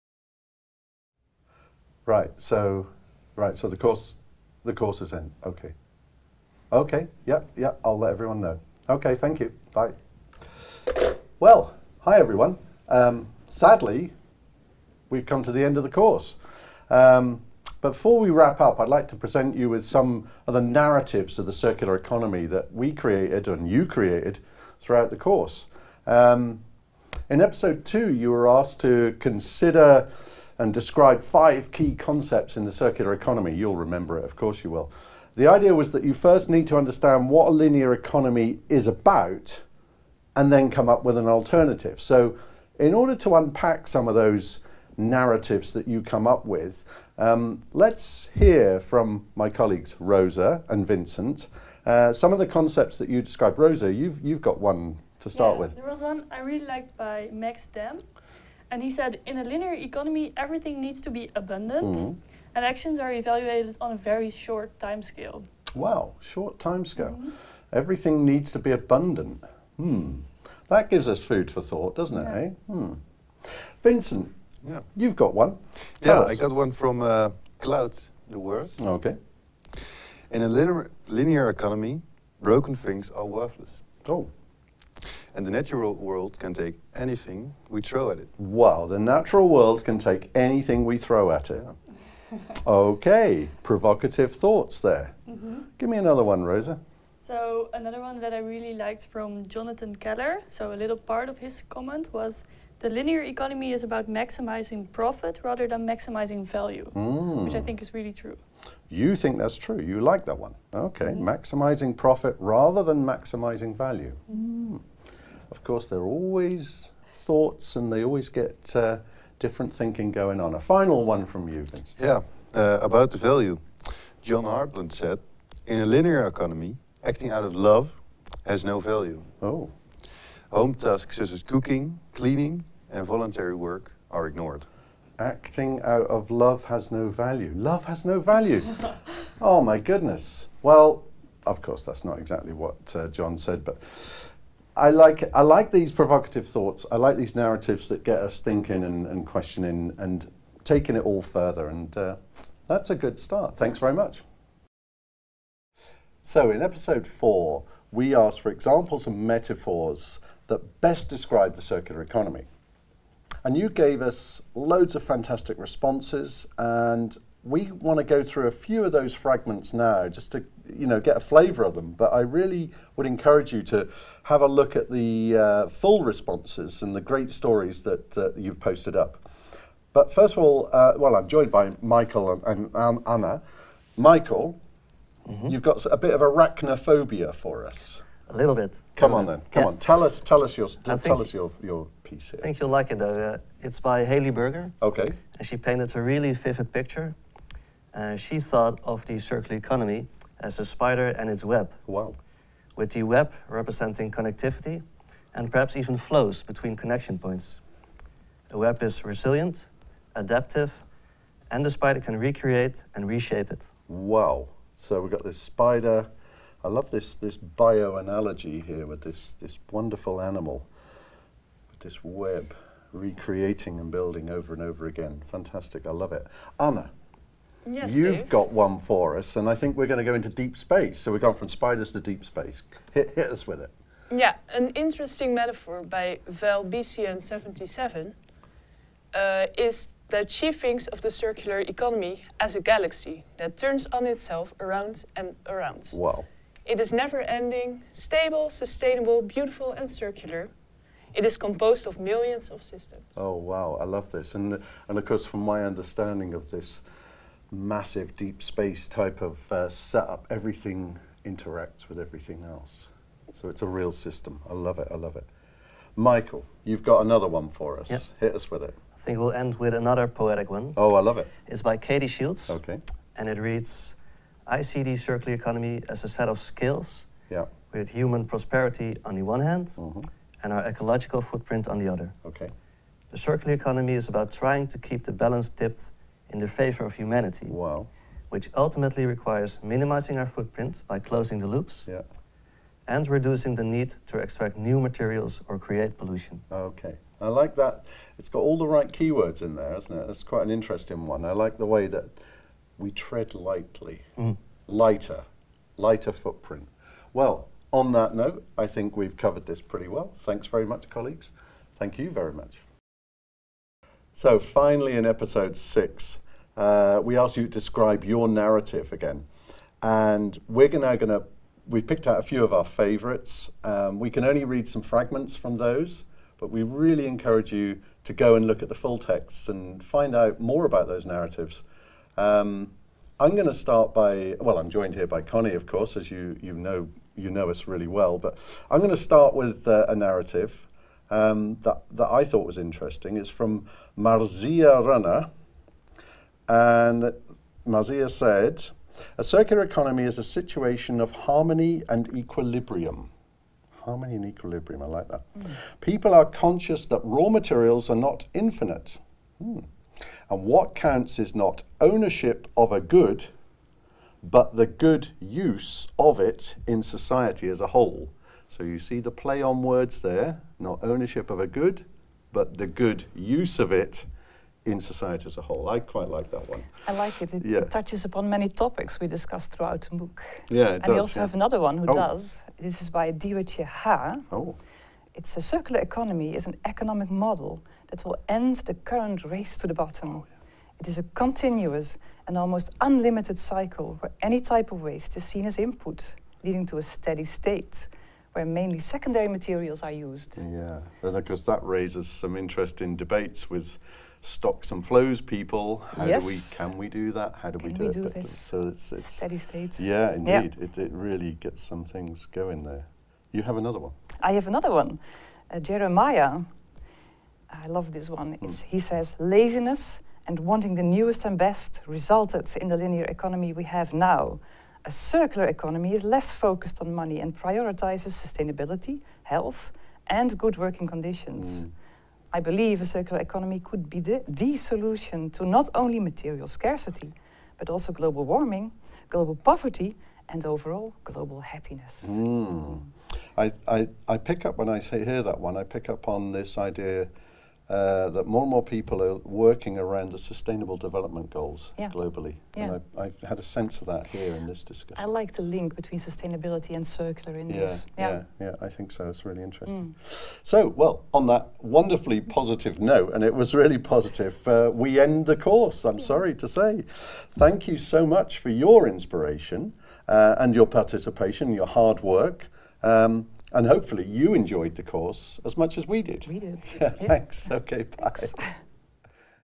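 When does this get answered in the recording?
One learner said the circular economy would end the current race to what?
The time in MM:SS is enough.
06:29.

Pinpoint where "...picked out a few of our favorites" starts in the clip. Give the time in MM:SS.
05:21.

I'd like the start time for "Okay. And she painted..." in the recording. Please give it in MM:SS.
03:14.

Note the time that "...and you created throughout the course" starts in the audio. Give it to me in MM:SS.
00:23.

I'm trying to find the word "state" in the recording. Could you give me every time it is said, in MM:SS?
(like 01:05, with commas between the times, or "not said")
06:37, 06:49.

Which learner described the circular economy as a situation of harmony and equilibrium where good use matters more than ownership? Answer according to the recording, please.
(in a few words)
Marzia Runner.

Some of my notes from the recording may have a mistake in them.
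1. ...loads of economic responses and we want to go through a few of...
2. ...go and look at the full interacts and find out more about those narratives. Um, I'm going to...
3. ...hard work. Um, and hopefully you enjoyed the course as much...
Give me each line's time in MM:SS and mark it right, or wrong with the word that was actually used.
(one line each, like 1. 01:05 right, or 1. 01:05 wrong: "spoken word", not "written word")
1. 02:44 wrong: "fantastic", not "economic"
2. 05:28 wrong: "texts", not "interacts"
3. 07:51 right.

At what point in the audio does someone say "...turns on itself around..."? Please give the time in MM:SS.
04:03.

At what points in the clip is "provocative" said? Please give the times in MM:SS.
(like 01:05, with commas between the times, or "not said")
01:33, 02:25.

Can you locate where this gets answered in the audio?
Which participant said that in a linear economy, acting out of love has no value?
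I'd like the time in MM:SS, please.
02:04.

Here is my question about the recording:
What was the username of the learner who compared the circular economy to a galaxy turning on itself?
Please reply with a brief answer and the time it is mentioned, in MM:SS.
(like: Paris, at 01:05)
Val BCN77, at 03:56.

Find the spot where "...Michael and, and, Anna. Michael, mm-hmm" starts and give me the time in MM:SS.
03:01.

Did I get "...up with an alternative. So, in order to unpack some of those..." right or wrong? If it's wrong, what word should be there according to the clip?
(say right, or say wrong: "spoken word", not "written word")
right.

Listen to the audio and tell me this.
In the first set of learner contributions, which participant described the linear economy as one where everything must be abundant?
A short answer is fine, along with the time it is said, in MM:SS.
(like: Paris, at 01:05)
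Max Dam, at 00:57.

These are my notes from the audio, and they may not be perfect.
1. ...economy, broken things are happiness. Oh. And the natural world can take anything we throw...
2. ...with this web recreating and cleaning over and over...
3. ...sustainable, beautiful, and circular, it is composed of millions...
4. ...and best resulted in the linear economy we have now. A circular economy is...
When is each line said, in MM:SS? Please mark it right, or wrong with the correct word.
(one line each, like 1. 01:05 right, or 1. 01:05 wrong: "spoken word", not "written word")
1. 01:21 wrong: "worthless", not "happiness"
2. 03:41 wrong: "building", not "cleaning"
3. 04:08 right
4. 07:01 right.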